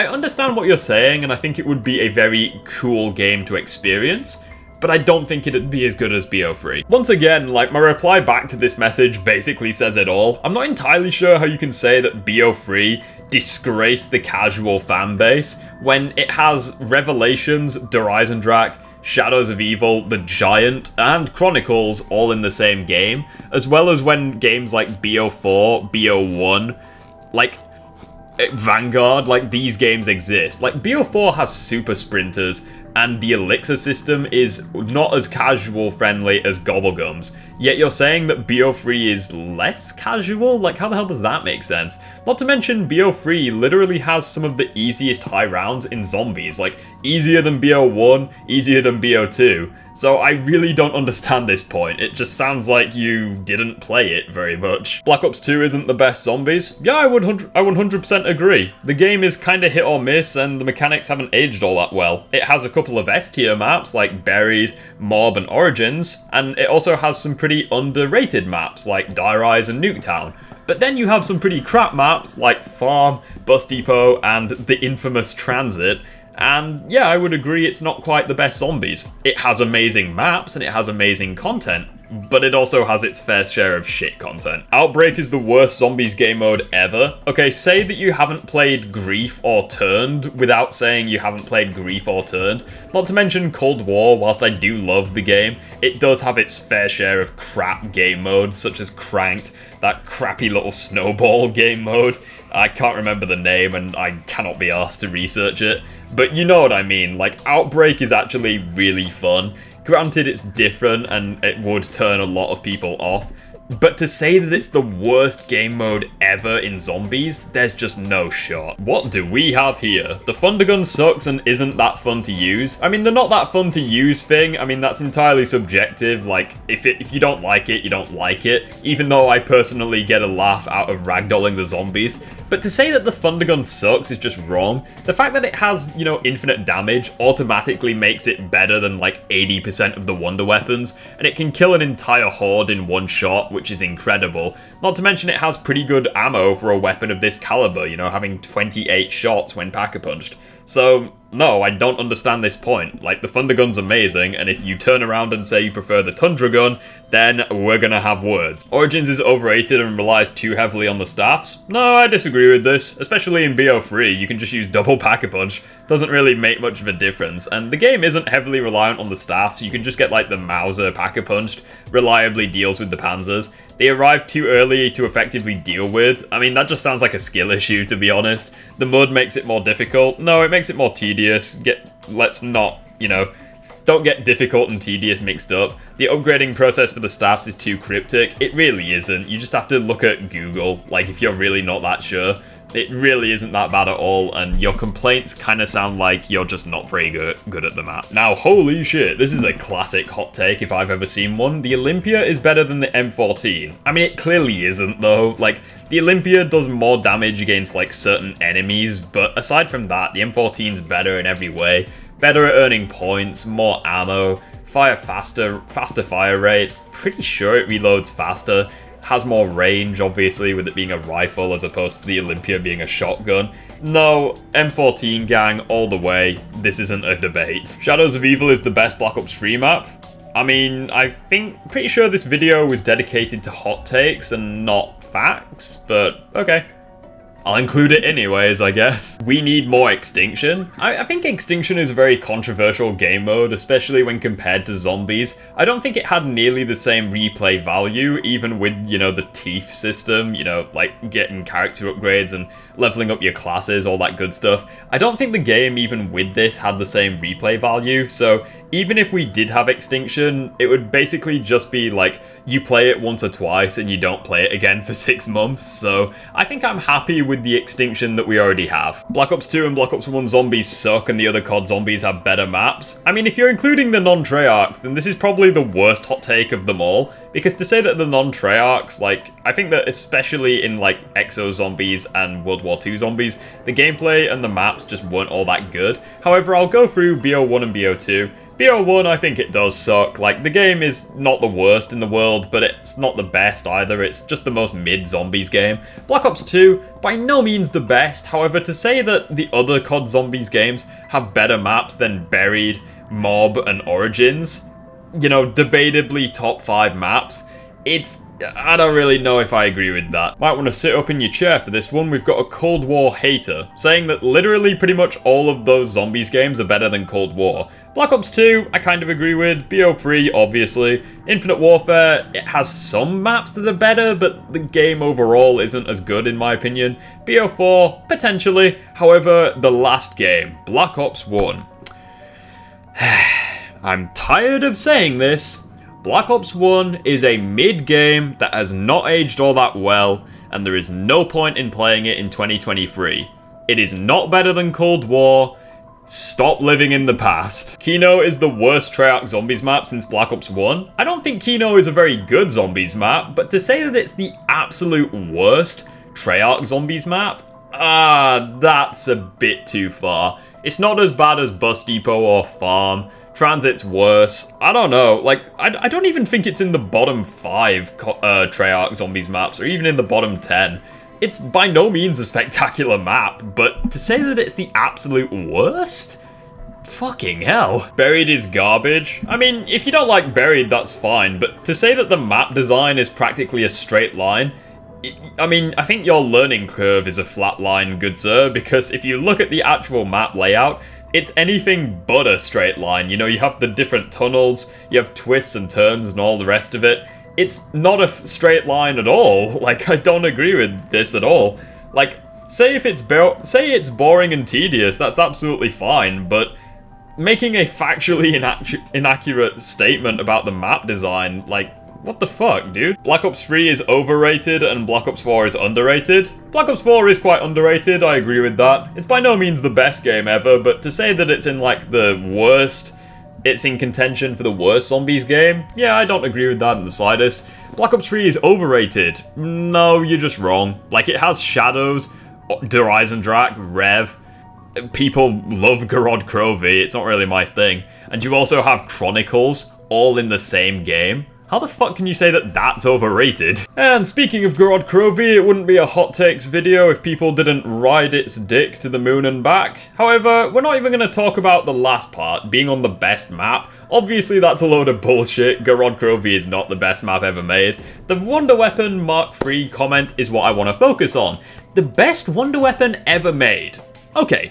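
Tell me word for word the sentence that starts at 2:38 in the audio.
Origins is overrated and relies too heavily on the staffs?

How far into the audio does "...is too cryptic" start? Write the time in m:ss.
3:07.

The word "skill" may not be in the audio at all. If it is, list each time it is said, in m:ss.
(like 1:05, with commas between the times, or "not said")
2:57.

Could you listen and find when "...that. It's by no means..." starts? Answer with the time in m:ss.
6:58.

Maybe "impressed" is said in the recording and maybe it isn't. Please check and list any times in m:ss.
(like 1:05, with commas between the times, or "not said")
not said.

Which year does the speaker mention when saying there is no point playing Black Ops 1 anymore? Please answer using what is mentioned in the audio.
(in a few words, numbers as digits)
2023.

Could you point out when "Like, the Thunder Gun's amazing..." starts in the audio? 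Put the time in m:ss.
2:33.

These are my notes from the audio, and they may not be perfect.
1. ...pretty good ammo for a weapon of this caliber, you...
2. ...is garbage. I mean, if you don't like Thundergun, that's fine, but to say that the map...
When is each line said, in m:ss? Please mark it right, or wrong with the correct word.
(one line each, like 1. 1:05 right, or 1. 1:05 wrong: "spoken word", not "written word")
1. 2:25 right
2. 6:18 wrong: "Buried", not "Thundergun".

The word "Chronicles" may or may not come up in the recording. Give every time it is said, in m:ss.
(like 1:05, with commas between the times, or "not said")
0:21, 7:18.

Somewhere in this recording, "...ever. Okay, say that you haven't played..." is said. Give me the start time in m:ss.
1:26.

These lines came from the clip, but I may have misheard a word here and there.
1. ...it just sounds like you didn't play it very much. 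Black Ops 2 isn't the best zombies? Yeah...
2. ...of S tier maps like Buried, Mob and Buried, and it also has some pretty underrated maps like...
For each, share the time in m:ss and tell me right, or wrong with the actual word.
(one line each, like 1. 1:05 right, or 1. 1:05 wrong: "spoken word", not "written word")
1. 0:51 right
2. 1:02 wrong: "Origins", not "Buried".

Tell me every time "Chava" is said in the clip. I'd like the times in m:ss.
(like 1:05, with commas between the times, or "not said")
not said.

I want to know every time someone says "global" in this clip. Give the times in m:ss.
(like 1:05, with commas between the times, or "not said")
not said.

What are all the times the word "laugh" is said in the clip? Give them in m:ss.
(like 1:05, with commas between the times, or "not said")
2:10.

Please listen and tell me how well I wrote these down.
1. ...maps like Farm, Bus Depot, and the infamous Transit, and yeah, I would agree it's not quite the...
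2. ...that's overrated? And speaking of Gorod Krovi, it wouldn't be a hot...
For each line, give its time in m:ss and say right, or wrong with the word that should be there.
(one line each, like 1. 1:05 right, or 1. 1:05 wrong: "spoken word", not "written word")
1. 1:11 right
2. 7:22 right.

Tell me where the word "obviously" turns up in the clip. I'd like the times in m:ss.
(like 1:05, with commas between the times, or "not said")
3:39, 5:20, 7:33.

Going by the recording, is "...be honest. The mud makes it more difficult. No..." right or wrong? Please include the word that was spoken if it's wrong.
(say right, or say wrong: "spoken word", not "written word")
right.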